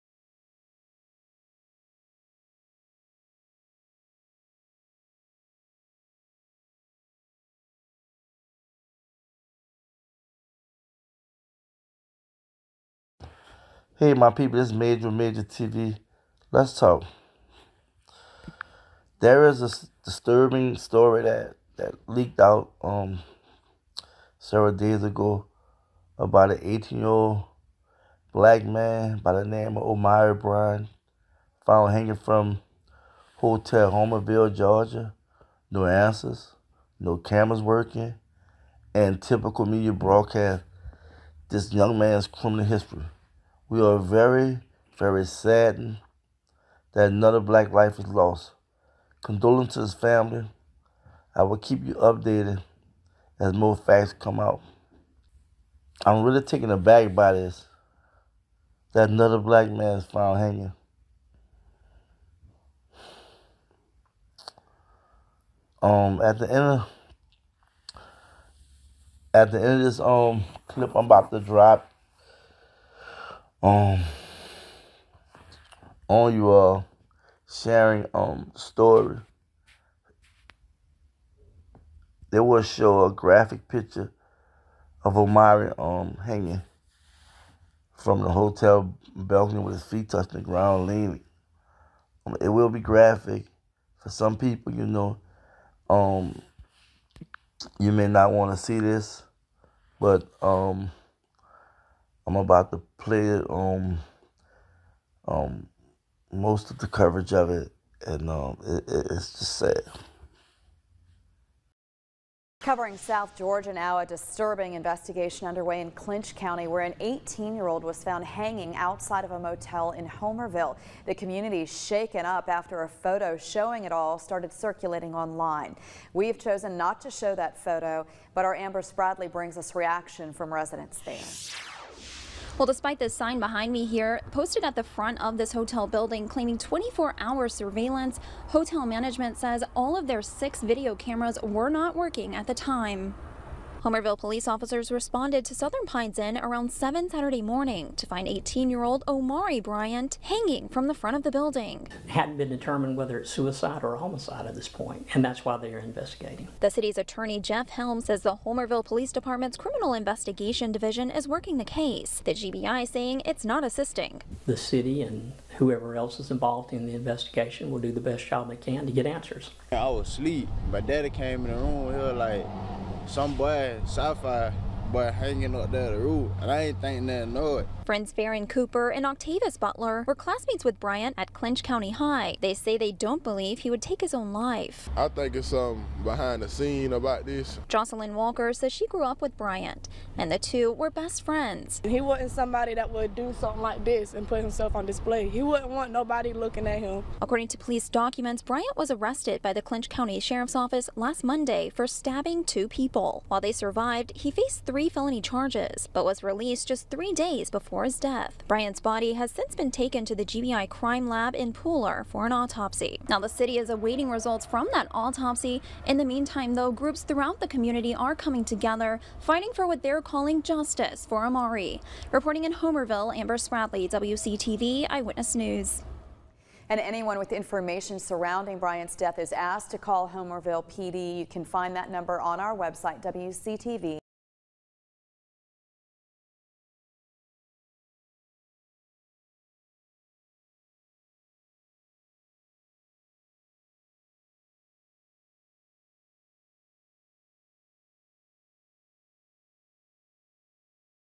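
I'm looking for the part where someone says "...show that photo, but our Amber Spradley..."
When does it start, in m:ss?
2:07.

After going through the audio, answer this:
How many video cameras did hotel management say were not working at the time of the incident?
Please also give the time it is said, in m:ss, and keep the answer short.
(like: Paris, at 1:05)
6, at 2:20.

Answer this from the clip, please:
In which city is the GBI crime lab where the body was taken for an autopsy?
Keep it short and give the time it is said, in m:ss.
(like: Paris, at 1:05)
Pooler, at 3:31.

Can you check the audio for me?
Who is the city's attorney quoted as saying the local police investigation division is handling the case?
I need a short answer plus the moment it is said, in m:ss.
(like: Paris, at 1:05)
Jeff Helm, at 2:37.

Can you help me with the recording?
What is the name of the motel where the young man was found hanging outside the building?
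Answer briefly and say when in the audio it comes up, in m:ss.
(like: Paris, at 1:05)
Southern Pines Inn, at 2:25.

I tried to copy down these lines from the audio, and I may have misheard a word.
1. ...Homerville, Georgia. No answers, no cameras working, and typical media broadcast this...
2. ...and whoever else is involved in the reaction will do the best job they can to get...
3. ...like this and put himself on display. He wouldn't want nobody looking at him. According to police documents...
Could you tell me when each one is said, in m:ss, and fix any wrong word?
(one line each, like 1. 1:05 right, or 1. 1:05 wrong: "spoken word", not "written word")
1. 0:33 right
2. 2:45 wrong: "investigation", not "reaction"
3. 3:13 right.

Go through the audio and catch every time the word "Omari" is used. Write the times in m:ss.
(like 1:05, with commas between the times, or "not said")
0:29, 1:25, 2:29, 3:41.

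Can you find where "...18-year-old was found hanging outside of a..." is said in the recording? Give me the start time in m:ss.
1:57.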